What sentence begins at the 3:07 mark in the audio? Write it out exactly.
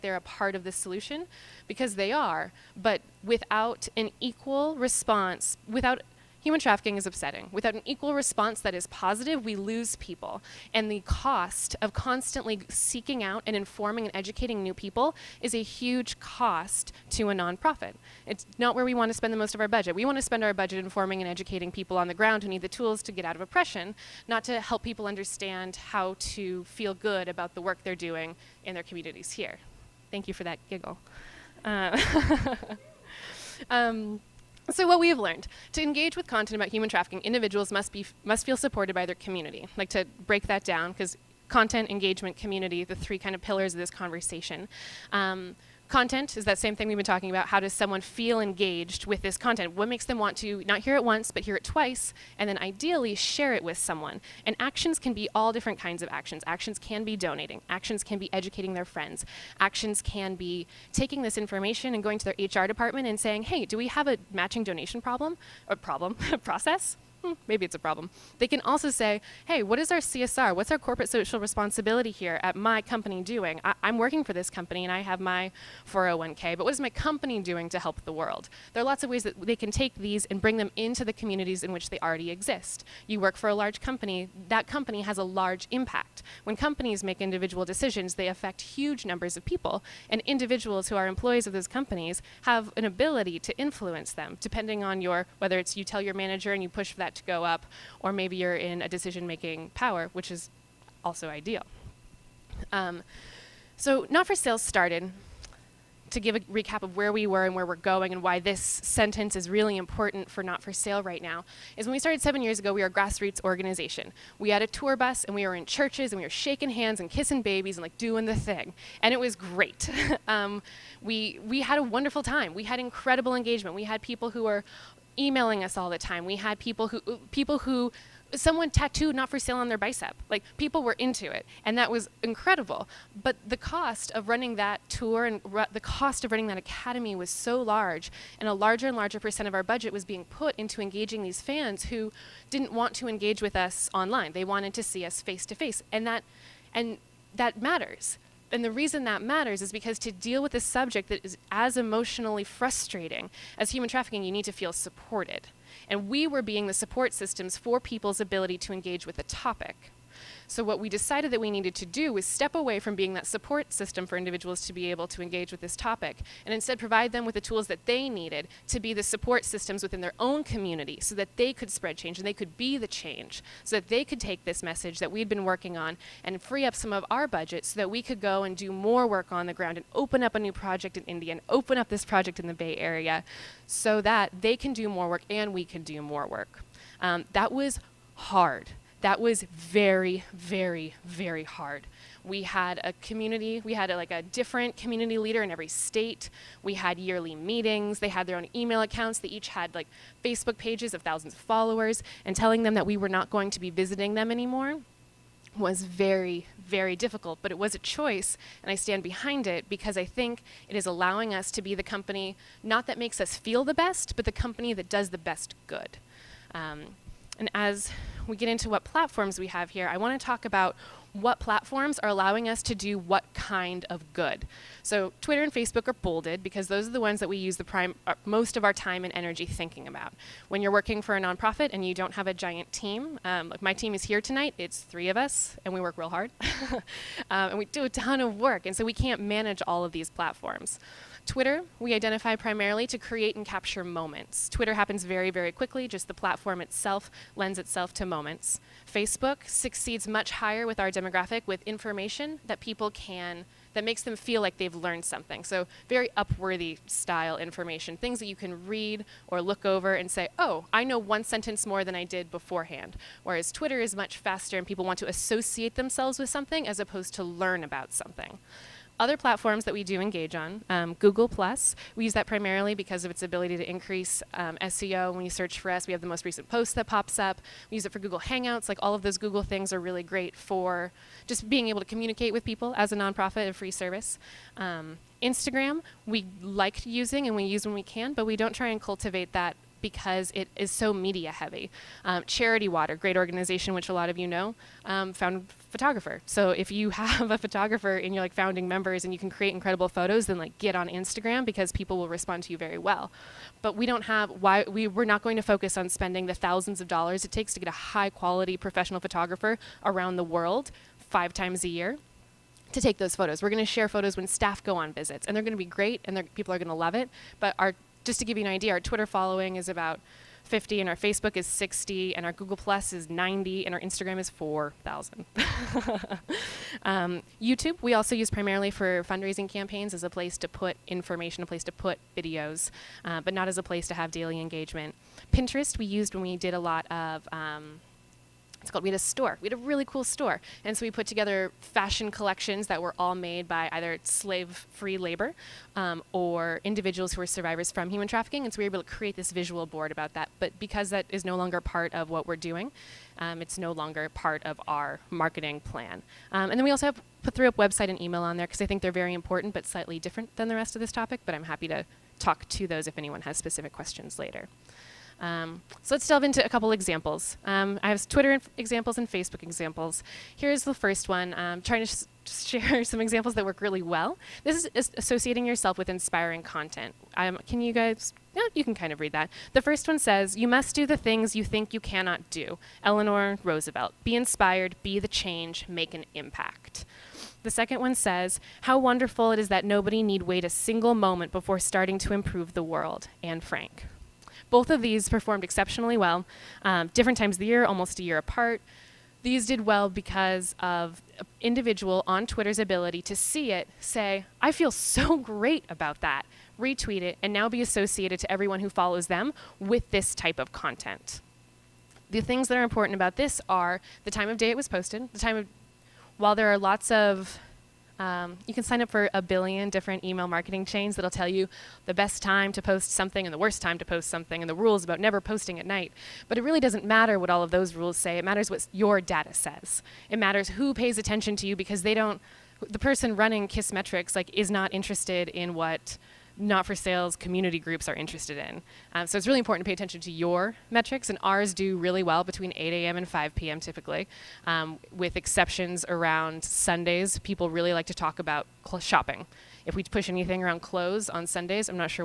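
Um, that was hard that was very, very, very hard.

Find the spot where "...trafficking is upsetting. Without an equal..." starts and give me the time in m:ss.
0:06.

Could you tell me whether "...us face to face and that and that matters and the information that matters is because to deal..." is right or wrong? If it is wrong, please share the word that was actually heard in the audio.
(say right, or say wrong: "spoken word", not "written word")
wrong: "reason", not "information".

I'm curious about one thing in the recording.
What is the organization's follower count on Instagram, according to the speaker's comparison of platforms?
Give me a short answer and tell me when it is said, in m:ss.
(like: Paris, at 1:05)
4,000, at 5:24.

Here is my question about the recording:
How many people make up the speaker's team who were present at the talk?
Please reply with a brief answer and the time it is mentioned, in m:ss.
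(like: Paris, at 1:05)
3, at 3:54.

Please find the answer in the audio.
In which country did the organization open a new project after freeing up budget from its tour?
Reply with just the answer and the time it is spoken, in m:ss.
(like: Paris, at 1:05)
India, at 3:01.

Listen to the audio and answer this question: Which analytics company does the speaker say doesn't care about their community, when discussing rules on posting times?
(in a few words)
KISSmetrics.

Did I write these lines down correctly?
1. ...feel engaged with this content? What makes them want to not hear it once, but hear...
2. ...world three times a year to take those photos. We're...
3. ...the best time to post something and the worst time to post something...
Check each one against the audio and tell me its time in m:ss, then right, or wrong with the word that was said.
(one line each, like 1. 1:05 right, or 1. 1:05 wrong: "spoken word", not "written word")
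1. 0:48 right
2. 5:10 wrong: "five", not "three"
3. 7:01 right.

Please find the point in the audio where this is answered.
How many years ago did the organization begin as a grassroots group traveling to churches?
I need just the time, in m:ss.
1:52.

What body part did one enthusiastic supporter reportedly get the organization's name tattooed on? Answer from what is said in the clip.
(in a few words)
bicep.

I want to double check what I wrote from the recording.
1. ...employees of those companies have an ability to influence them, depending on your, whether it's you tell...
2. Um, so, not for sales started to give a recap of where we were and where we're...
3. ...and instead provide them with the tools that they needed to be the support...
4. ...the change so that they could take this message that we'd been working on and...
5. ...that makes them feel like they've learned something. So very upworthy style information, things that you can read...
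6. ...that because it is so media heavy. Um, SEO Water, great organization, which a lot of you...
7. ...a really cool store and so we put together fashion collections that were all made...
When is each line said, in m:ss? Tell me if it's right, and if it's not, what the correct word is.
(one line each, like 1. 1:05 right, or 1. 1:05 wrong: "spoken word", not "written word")
1. 1:31 right
2. 1:42 right
3. 2:46 right
4. 2:52 right
5. 4:13 right
6. 4:49 wrong: "Charity", not "SEO"
7. 5:39 right.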